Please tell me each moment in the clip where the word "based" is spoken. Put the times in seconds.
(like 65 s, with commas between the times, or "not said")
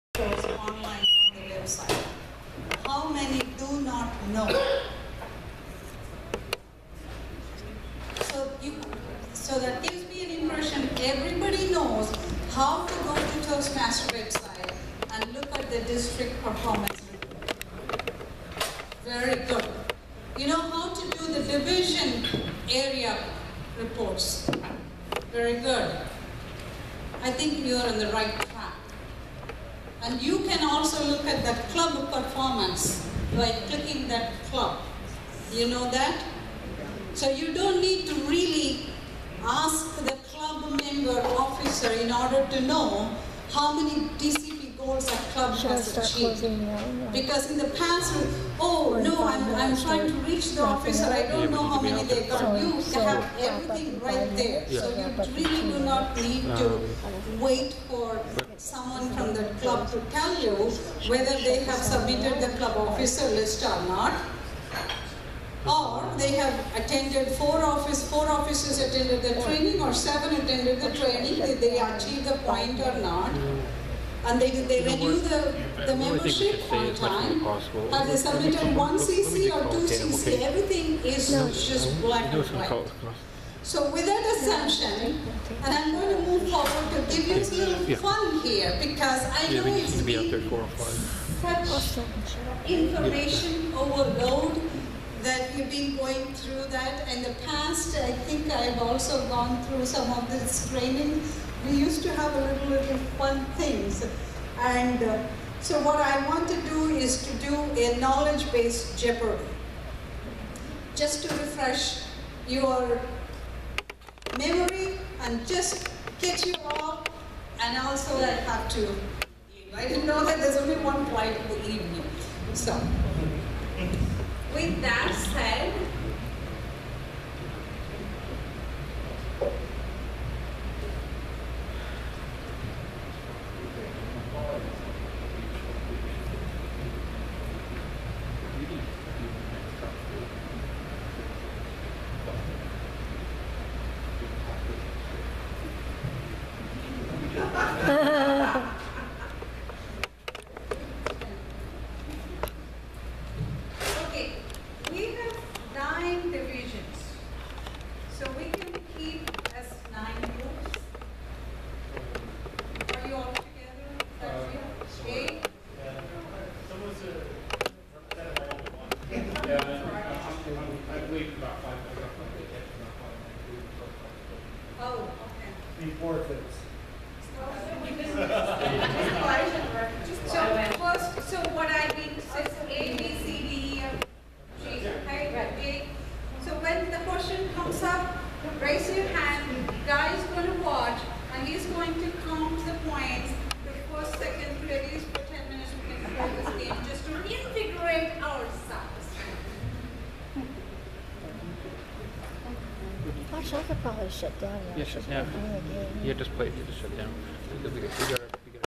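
107 s.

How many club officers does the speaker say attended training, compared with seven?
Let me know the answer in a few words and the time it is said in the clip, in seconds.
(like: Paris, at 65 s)
4, at 68 s.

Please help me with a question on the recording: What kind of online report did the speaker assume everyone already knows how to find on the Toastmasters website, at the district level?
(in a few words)
district performance report.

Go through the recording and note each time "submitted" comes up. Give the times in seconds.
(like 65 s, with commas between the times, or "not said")
61 s, 78 s.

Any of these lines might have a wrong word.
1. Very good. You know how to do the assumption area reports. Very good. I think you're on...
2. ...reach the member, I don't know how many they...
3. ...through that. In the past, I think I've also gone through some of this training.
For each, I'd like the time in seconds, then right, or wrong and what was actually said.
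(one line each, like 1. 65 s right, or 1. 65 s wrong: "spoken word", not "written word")
1. 19 s wrong: "division", not "assumption"
2. 50 s wrong: "officer", not "member"
3. 96 s right.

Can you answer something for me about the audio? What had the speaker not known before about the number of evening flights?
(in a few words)
only one flight.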